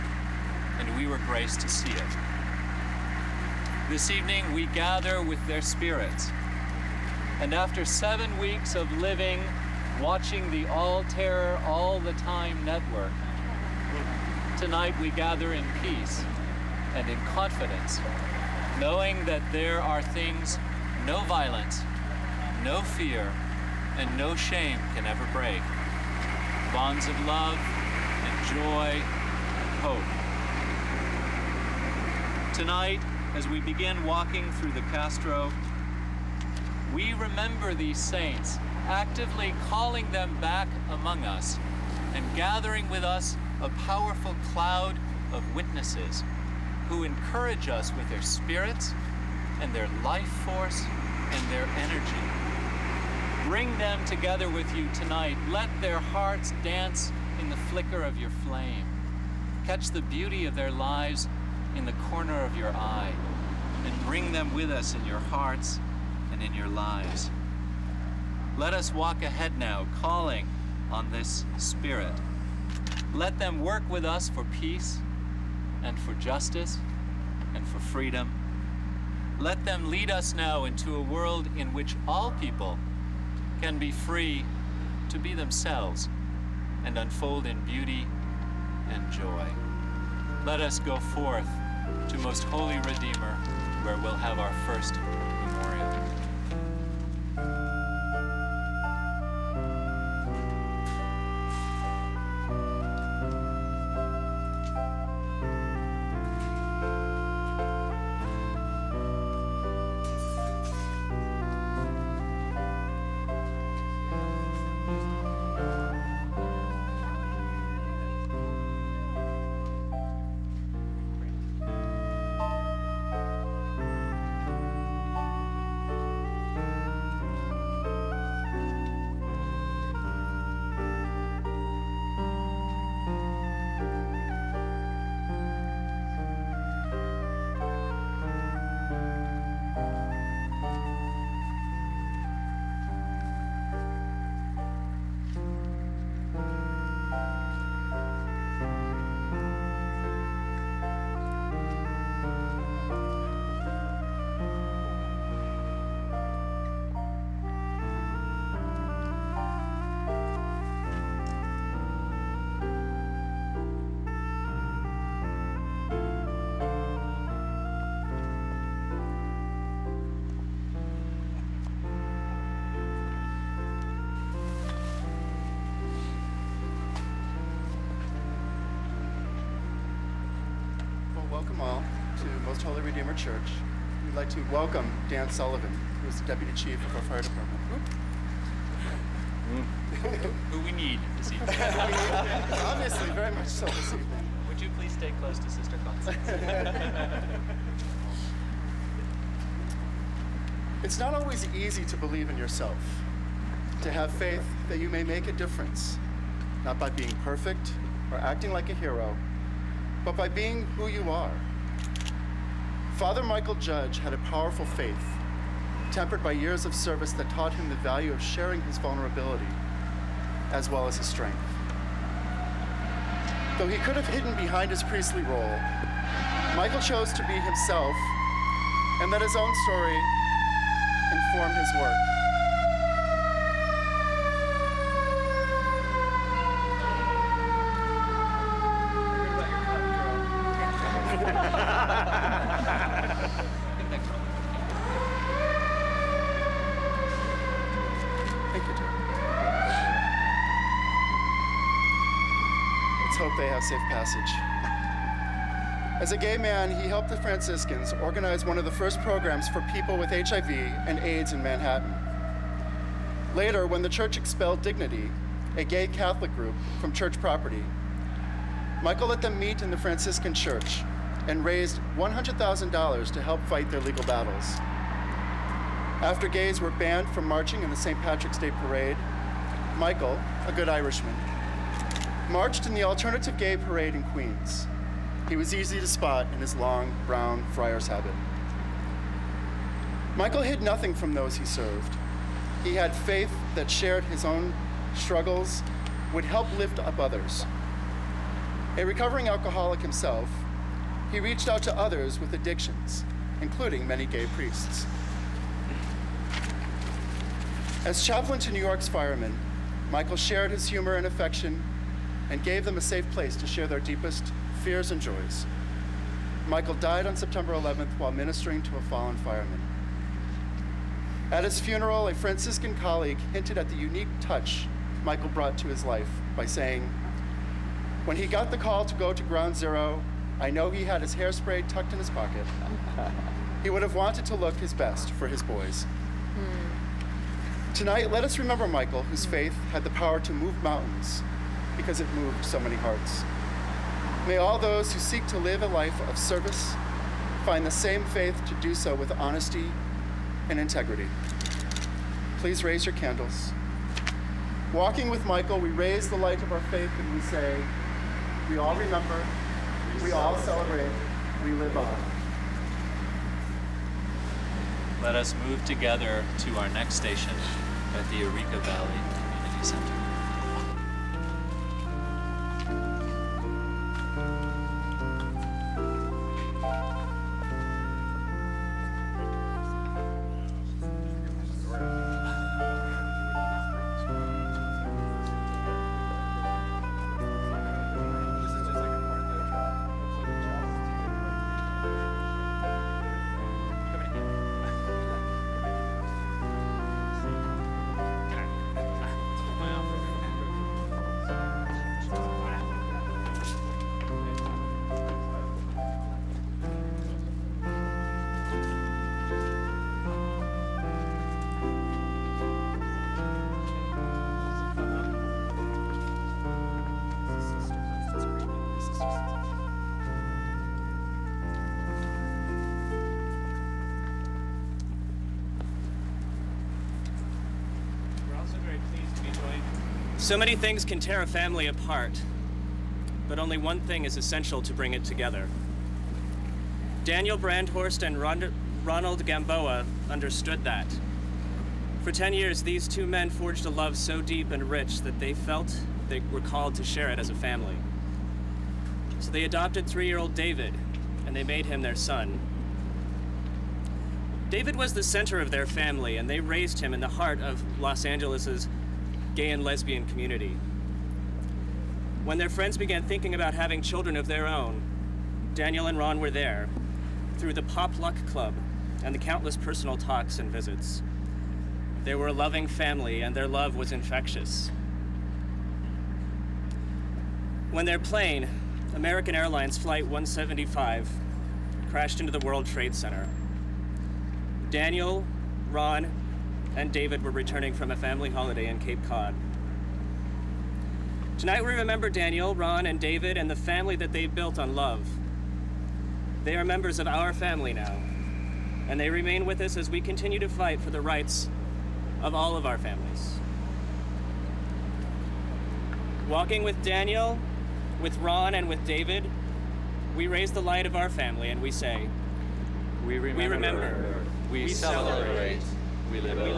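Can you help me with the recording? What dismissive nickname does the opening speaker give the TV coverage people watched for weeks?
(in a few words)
All Terror All the Time network.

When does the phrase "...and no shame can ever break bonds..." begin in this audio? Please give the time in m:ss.
0:23.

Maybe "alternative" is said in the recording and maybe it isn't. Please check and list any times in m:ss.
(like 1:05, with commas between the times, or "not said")
4:42.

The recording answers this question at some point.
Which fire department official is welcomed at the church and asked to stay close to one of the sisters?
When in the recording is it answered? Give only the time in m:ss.
3:05.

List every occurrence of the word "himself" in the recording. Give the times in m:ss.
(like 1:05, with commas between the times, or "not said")
3:47, 4:59.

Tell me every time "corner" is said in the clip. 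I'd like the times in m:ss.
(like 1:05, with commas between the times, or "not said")
1:01.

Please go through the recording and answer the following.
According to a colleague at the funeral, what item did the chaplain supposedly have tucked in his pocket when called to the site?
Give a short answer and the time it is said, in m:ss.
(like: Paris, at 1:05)
hairspray, at 5:31.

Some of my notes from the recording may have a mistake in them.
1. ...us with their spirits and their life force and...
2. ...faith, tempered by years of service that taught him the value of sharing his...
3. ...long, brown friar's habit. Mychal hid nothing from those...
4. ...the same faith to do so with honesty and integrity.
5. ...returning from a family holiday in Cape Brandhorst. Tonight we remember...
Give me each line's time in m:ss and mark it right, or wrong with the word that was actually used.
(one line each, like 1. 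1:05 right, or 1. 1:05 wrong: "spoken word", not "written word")
1. 0:47 right
2. 3:34 right
3. 4:46 right
4. 5:47 right
5. 8:07 wrong: "Cod", not "Brandhorst".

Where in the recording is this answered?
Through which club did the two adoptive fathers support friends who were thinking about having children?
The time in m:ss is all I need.
7:47.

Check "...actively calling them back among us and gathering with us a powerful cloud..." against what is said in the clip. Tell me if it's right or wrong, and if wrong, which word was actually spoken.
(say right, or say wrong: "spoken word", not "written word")
right.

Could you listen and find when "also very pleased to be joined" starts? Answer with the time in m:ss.
7:08.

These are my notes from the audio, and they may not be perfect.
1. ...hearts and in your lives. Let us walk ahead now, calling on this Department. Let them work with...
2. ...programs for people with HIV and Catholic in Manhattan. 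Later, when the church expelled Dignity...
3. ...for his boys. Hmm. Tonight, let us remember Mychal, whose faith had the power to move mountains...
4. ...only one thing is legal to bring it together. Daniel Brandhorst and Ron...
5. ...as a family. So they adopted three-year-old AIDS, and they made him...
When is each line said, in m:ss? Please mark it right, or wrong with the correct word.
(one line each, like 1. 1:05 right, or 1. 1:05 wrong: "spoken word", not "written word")
1. 1:05 wrong: "Spirit", not "Department"
2. 4:19 wrong: "AIDS", not "Catholic"
3. 5:35 right
4. 7:13 wrong: "essential", not "legal"
5. 7:27 wrong: "David", not "AIDS".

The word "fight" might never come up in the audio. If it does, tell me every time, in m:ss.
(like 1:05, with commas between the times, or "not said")
4:33, 8:20.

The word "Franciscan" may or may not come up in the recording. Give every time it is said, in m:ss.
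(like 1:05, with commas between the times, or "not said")
4:17, 4:29, 5:22.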